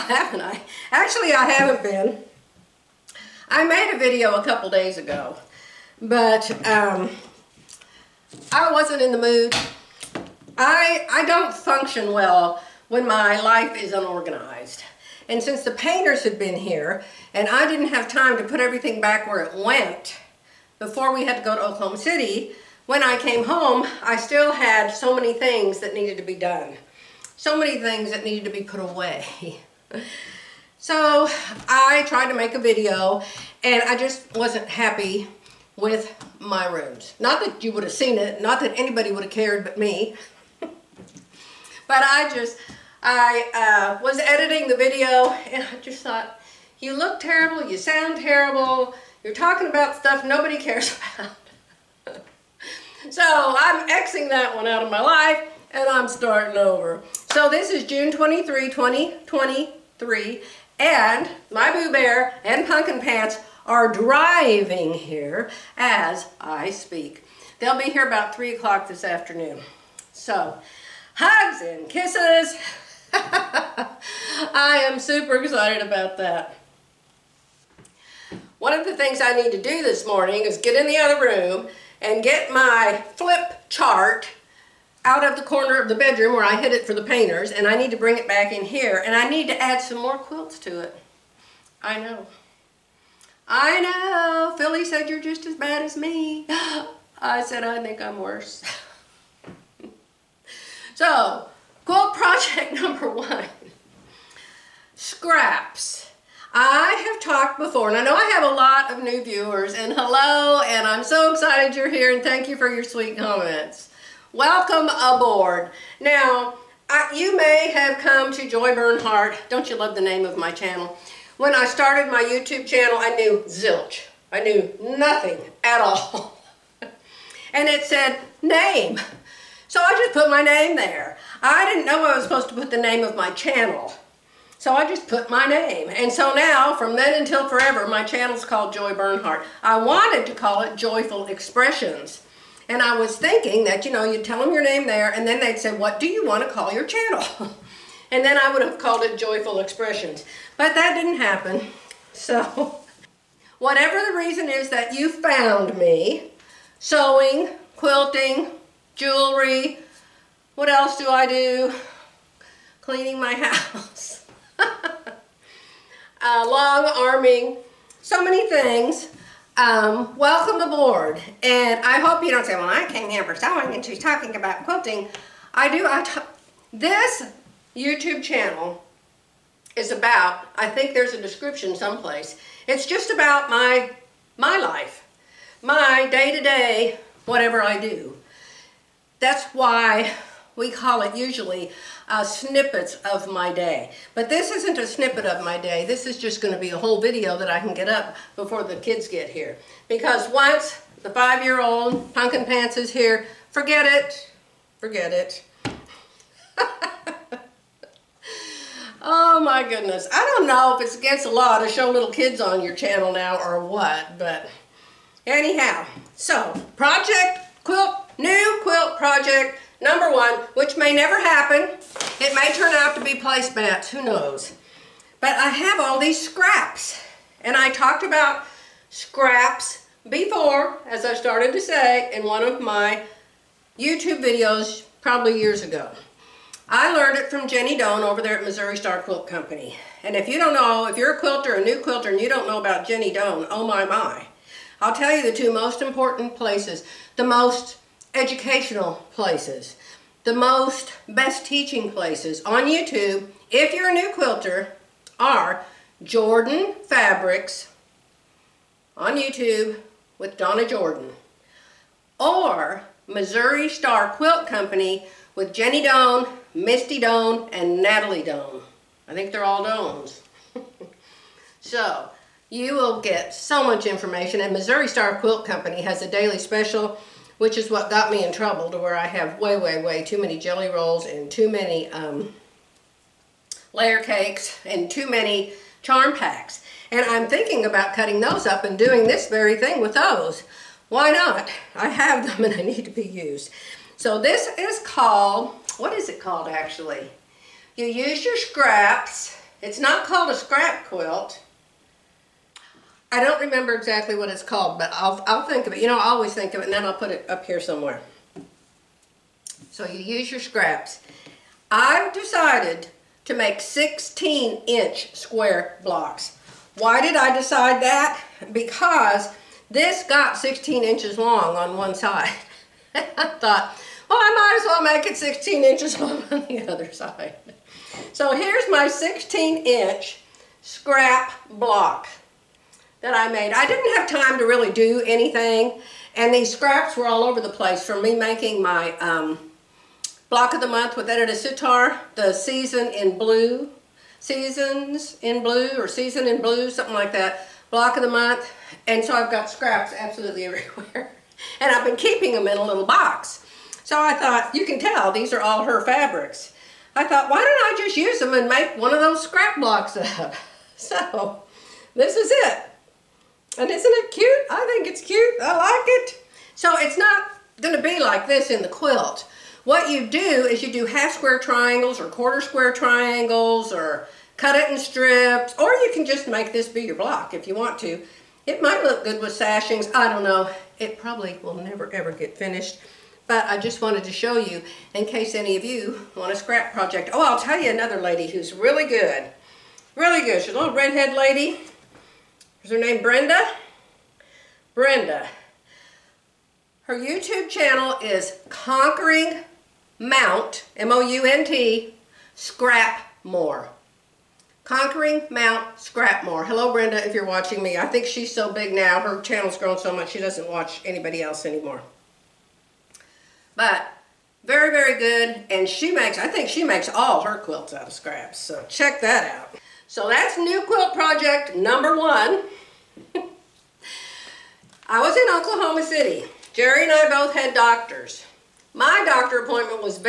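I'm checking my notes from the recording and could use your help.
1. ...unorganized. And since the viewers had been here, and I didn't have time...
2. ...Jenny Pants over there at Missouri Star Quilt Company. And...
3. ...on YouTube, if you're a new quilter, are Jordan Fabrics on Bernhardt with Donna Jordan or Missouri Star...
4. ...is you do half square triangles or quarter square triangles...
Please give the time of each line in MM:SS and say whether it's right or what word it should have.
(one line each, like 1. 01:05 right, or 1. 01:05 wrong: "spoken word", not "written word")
1. 00:13 wrong: "painters", not "viewers"
2. 03:57 wrong: "Doan", not "Pants"
3. 04:12 wrong: "YouTube", not "Bernhardt"
4. 06:10 right.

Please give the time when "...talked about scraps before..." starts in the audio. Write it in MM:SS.
03:47.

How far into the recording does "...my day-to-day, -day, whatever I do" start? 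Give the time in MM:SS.
03:05.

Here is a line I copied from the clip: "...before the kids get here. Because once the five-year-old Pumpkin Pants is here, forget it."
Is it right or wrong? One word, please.
right.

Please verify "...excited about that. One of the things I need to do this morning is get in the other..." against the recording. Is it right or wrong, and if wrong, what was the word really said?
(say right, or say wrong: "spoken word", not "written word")
right.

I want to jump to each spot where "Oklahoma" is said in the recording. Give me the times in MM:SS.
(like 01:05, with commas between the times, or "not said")
00:21, 07:05.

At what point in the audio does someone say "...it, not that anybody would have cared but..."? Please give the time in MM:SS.
00:38.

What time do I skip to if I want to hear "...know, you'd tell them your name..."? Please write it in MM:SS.
02:23.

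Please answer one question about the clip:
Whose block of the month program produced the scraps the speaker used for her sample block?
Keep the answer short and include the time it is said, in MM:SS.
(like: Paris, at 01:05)
Edyta Sitar, at 05:41.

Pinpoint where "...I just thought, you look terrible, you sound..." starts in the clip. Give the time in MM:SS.
00:45.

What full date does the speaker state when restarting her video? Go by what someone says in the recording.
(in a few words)
June 23, 2023.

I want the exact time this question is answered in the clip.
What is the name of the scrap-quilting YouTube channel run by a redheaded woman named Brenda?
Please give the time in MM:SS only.
06:44.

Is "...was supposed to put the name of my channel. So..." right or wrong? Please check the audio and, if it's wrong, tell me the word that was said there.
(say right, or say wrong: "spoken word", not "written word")
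right.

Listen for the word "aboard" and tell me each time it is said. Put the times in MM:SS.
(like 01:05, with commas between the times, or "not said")
01:54, 02:50.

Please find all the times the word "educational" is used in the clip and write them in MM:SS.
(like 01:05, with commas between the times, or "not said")
04:08.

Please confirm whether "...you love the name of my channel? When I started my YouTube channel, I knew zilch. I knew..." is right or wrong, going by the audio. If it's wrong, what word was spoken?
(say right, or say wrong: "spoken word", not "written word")
right.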